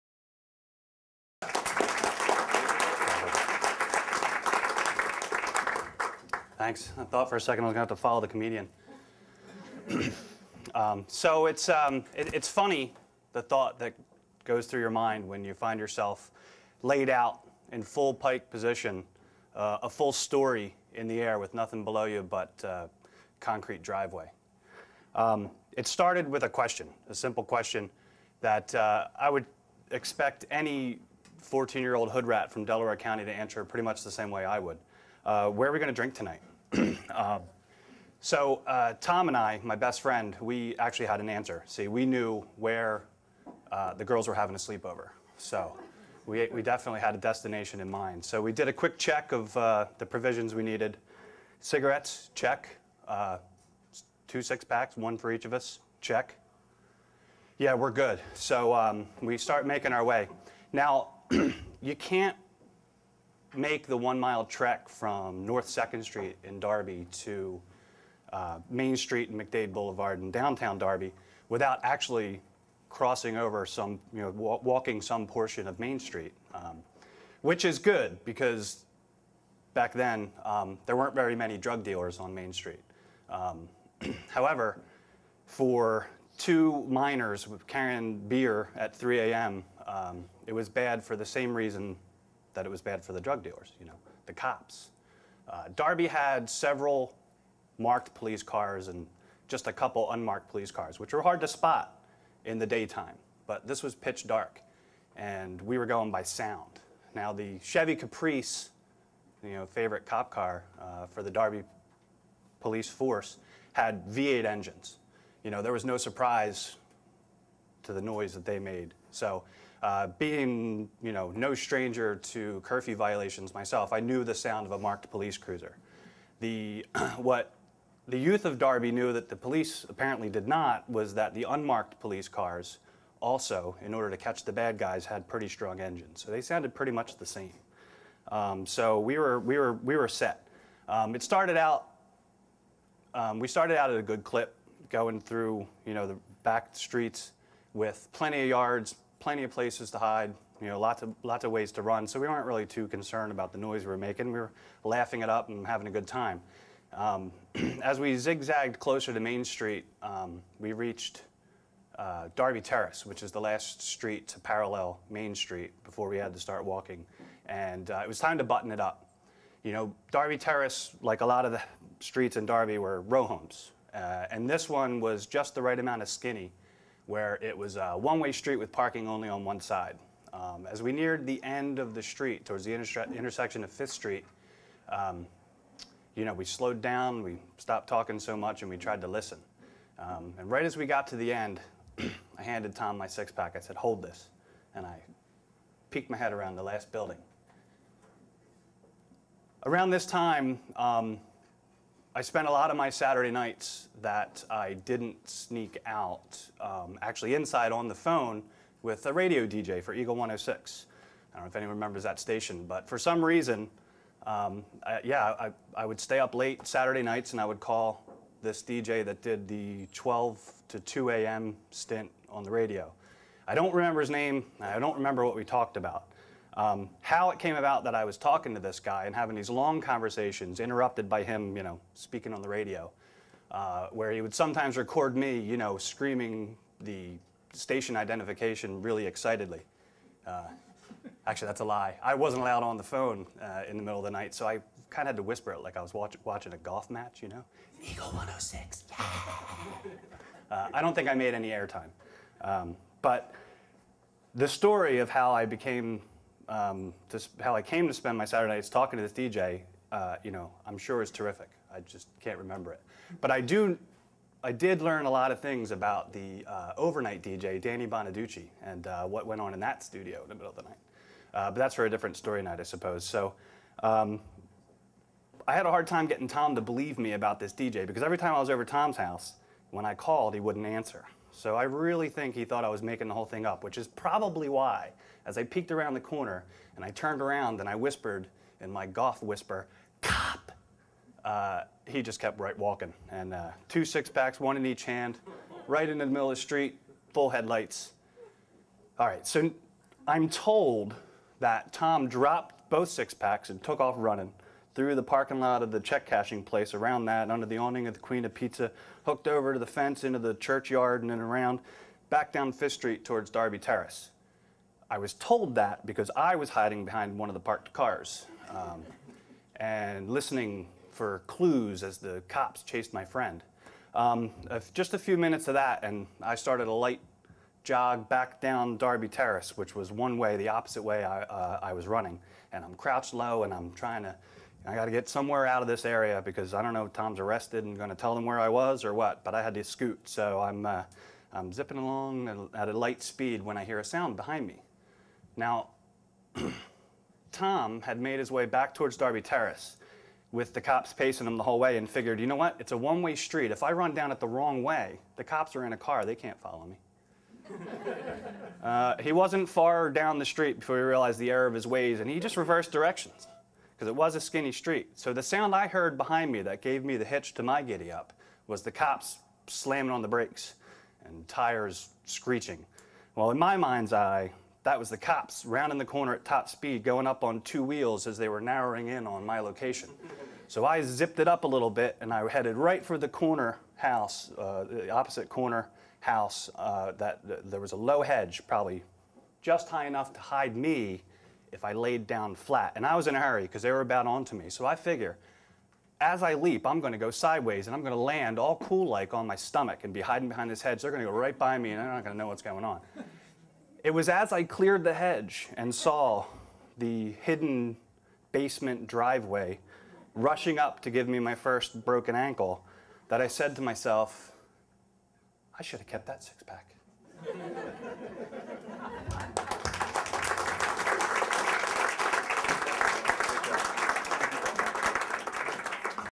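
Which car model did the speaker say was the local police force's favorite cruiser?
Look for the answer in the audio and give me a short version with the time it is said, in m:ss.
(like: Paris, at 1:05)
Chevy Caprice, at 1:47.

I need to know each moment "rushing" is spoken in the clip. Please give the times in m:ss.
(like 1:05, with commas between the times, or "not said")
6:50.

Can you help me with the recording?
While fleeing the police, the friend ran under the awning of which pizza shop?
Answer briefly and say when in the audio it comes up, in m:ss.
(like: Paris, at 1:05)
Queen of Pizza, at 5:07.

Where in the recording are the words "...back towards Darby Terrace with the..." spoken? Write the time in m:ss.
5:48.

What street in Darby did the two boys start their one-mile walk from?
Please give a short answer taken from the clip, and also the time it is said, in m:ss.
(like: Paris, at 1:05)
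North 2nd Street, at 1:05.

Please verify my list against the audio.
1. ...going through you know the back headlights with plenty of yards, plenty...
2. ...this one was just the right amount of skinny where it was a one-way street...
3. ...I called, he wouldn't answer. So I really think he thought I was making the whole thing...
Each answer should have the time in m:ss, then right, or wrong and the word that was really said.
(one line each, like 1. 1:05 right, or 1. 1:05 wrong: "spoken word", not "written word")
1. 2:24 wrong: "streets", not "headlights"
2. 2:54 right
3. 4:39 right.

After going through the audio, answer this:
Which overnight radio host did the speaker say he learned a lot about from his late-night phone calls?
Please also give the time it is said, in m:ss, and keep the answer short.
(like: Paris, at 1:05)
Danny Bonaduce, at 4:27.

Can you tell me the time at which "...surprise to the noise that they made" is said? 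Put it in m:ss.
1:55.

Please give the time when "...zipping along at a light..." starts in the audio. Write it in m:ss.
5:41.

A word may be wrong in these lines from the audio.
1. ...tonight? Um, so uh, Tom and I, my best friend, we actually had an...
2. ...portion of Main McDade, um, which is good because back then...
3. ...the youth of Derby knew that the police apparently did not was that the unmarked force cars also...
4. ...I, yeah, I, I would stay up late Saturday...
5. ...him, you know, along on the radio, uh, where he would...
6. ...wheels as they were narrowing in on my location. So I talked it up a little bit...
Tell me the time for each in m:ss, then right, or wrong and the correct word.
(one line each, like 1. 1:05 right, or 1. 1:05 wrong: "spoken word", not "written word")
1. 0:36 right
2. 1:15 wrong: "Street", not "McDade"
3. 2:08 wrong: "police", not "force"
4. 3:34 right
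5. 3:51 wrong: "speaking", not "along"
6. 6:17 wrong: "zipped", not "talked".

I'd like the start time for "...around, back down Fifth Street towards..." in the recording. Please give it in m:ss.
5:11.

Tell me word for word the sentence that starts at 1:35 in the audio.
Uh, Darby had several marked police cars and just a couple unmarked police cars, which were hard to spot in the daytime.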